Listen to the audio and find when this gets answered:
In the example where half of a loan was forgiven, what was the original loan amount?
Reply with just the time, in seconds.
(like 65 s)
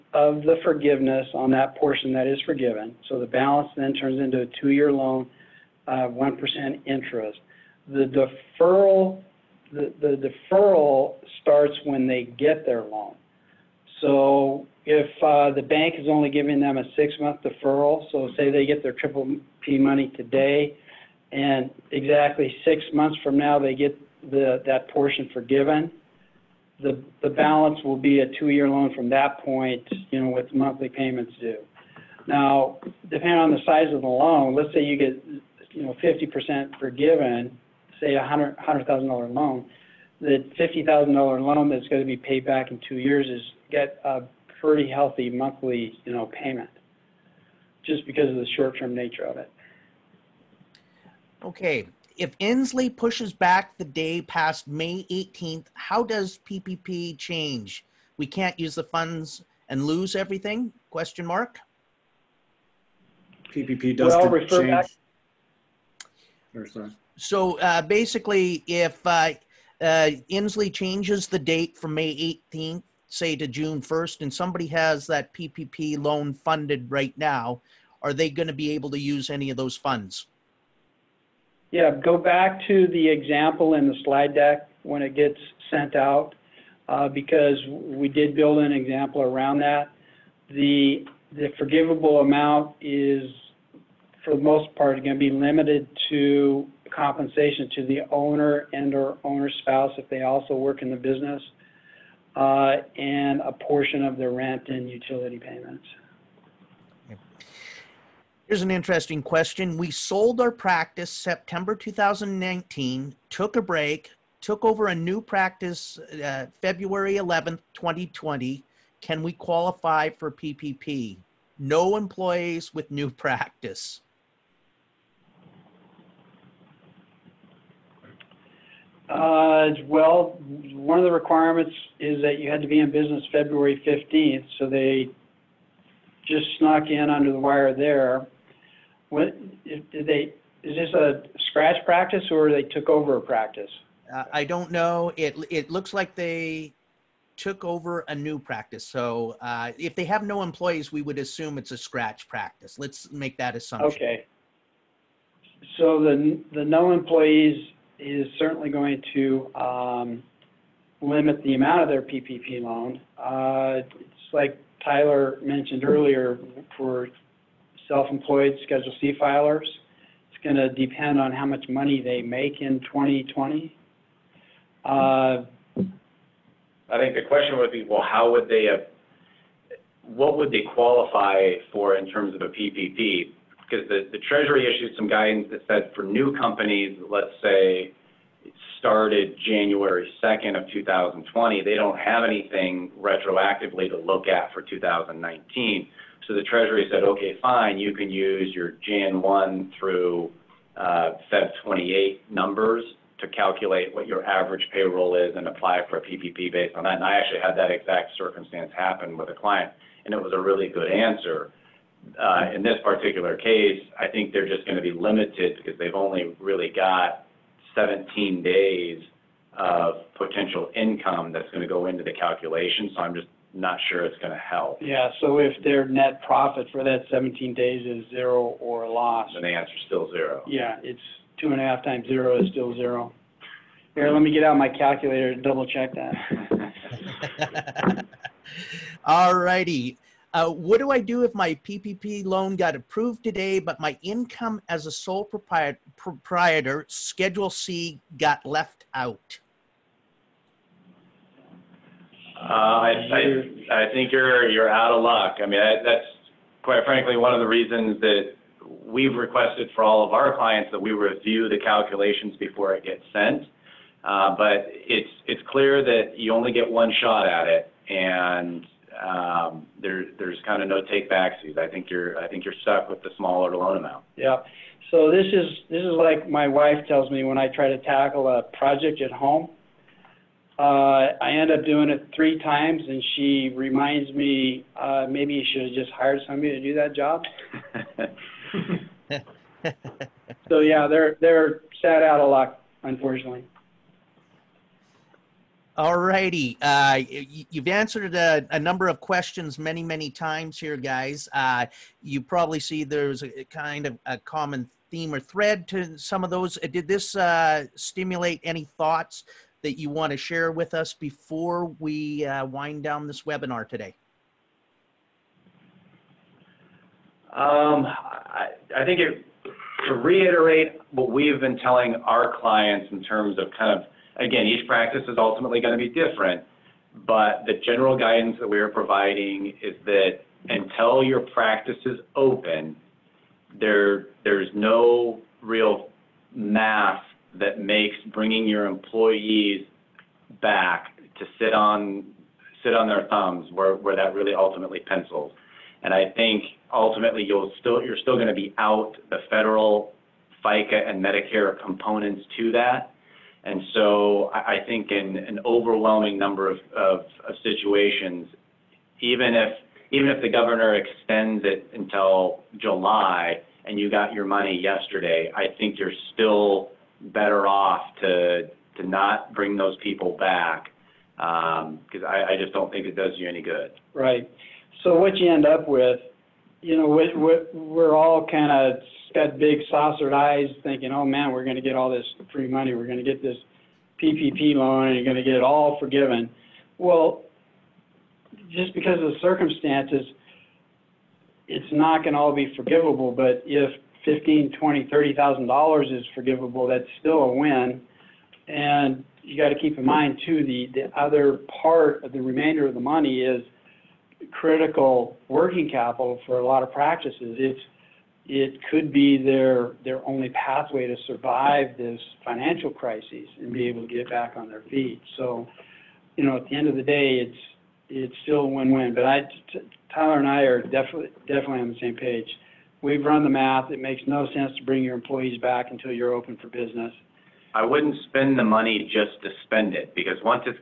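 38 s.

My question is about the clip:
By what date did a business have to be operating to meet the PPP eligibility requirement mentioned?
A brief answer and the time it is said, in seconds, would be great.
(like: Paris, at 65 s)
February 15th, at 133 s.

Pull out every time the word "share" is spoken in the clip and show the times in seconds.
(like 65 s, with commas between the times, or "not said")
310 s.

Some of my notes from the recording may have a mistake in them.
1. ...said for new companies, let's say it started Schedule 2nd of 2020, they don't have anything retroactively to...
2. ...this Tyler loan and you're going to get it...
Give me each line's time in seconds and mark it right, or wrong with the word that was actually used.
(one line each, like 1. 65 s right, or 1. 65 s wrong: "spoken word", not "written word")
1. 185 s wrong: "January", not "Schedule"
2. 383 s wrong: "PPP", not "Tyler".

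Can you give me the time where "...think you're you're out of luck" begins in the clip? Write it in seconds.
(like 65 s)
253 s.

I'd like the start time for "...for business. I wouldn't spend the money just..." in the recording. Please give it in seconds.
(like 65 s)
426 s.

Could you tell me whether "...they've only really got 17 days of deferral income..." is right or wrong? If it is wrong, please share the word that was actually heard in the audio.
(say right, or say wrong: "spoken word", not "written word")
wrong: "potential", not "deferral".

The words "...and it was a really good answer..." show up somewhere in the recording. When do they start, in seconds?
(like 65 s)
210 s.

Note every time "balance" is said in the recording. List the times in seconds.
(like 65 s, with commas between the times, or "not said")
3 s, 27 s.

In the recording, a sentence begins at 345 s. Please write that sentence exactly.
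And I think ultimately you'll still you're still going to be out the federal, FICA, and Medicare components to that.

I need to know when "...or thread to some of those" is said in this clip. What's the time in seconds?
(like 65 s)
305 s.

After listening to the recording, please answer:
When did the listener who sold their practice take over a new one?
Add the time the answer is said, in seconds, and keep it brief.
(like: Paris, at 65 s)
February 11th, 2020, at 116 s.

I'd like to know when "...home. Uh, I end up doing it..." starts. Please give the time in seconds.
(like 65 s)
279 s.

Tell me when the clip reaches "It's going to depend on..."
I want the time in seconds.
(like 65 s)
170 s.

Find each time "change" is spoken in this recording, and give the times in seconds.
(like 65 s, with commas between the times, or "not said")
57 s, 64 s, 70 s.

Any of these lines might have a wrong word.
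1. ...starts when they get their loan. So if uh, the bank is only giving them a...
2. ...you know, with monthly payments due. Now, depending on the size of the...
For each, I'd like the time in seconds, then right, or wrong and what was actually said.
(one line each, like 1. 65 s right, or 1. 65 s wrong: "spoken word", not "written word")
1. 11 s right
2. 30 s right.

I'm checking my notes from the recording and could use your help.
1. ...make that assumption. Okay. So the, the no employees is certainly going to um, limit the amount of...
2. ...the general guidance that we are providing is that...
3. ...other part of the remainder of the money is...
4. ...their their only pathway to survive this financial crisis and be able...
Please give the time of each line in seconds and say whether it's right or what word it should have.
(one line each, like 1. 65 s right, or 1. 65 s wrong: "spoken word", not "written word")
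1. 153 s right
2. 327 s right
3. 400 s right
4. 409 s right.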